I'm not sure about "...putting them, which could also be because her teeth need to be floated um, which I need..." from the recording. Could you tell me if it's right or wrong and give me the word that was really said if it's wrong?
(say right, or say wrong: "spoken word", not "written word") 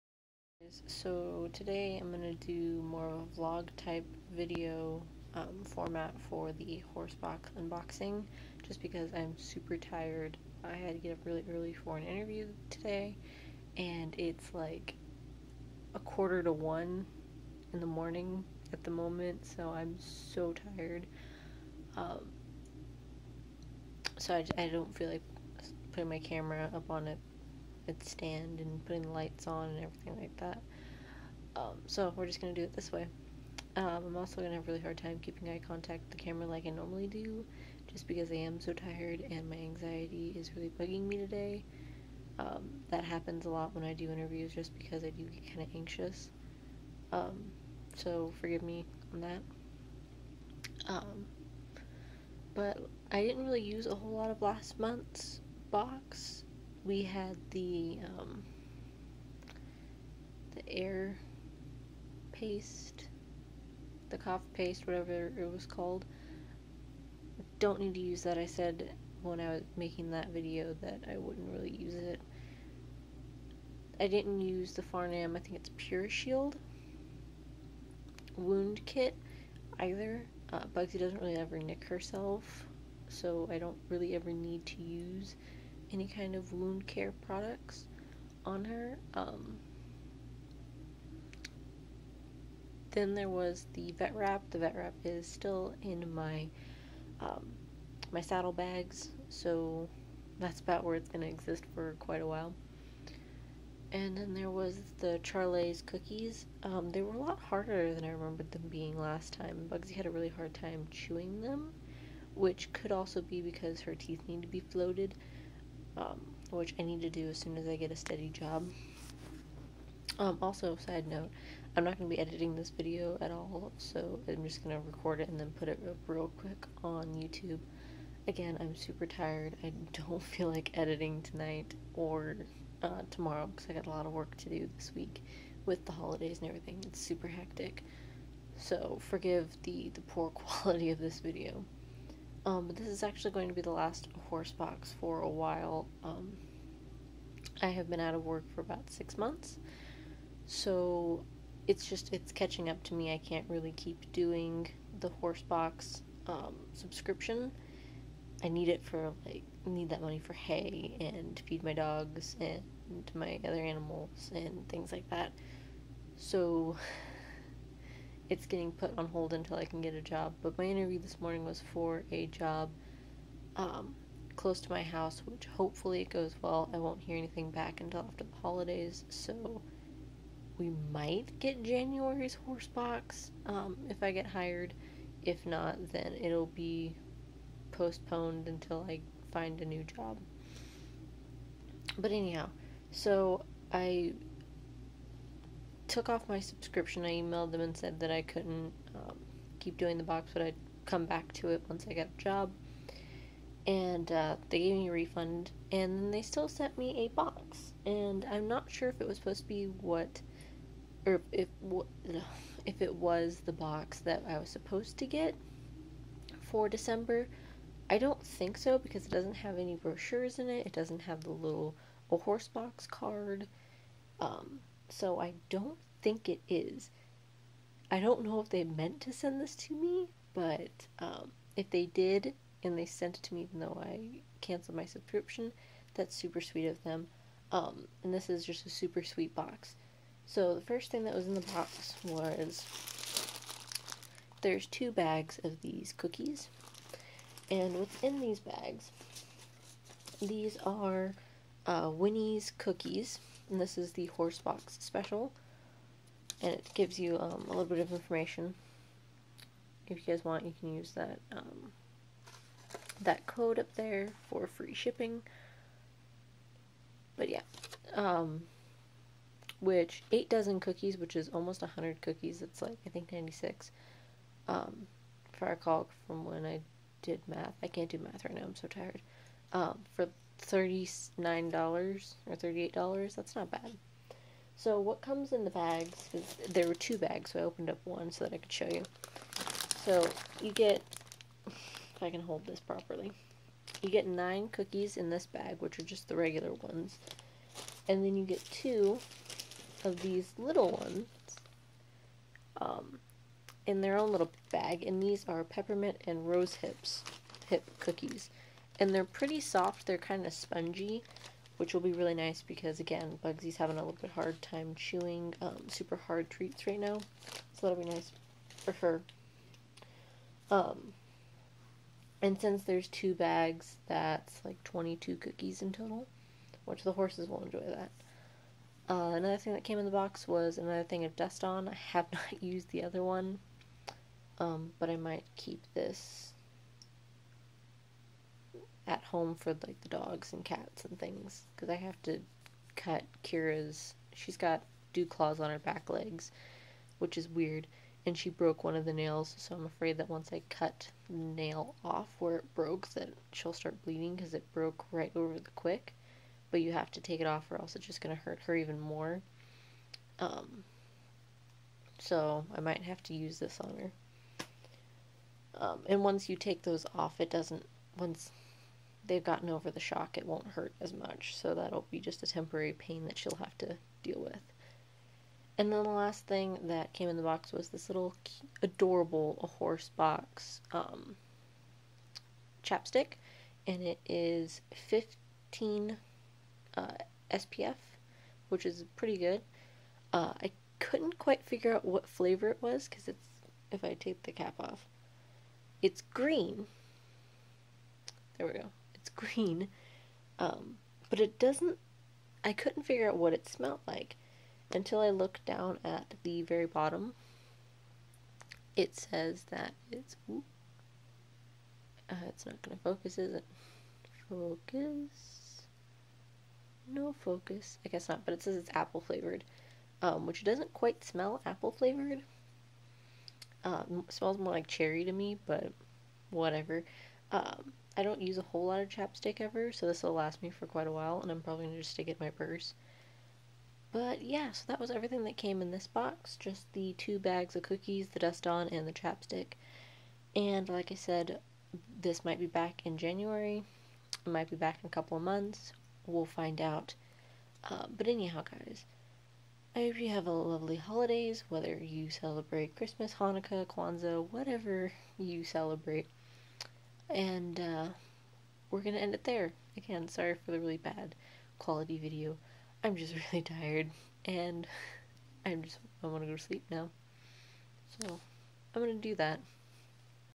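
wrong: "chewing", not "putting".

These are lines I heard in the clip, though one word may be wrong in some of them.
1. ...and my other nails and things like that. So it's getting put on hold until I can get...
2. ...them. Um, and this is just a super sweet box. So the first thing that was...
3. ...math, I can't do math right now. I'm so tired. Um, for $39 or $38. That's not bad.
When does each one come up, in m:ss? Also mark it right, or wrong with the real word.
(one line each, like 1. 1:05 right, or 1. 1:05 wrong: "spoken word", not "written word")
1. 2:42 wrong: "animals", not "nails"
2. 3:56 right
3. 4:37 right.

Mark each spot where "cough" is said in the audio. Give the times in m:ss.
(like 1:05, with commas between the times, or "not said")
1:04.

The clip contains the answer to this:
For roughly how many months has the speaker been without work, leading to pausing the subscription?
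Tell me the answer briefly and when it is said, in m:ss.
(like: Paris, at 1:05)
6, at 2:28.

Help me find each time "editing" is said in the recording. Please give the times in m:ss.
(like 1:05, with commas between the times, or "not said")
2:02, 2:10.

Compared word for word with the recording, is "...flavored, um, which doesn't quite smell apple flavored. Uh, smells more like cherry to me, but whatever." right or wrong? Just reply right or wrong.
right.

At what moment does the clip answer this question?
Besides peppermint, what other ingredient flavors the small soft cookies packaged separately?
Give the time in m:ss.
5:06.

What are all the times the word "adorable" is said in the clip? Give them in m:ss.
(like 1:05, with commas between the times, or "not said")
6:18.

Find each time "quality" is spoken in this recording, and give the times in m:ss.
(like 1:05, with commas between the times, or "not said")
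2:20, 7:41.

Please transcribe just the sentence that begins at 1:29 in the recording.
Um, then there was the vet wrap.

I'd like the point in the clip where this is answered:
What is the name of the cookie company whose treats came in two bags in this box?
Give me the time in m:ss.
4:11.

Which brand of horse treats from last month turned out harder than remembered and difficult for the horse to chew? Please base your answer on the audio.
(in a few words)
Charlie's cookies.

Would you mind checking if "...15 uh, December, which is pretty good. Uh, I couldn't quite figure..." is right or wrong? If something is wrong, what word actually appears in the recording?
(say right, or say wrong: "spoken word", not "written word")
wrong: "SPF", not "December".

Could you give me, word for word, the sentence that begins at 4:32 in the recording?
It's like I think ninety six.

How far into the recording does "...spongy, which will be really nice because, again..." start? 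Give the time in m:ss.
5:10.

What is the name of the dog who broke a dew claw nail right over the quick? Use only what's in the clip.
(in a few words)
Kira.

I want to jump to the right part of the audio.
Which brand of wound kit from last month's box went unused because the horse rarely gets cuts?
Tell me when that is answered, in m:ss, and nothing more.
1:15.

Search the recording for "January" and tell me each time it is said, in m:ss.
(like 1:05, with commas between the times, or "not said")
3:01, 7:22.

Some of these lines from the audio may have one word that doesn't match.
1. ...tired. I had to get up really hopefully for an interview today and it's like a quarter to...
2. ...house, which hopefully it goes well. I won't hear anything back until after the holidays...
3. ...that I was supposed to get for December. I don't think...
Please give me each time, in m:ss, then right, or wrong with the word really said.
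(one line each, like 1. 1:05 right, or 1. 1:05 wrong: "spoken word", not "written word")
1. 0:09 wrong: "early", not "hopefully"
2. 2:54 right
3. 3:33 right.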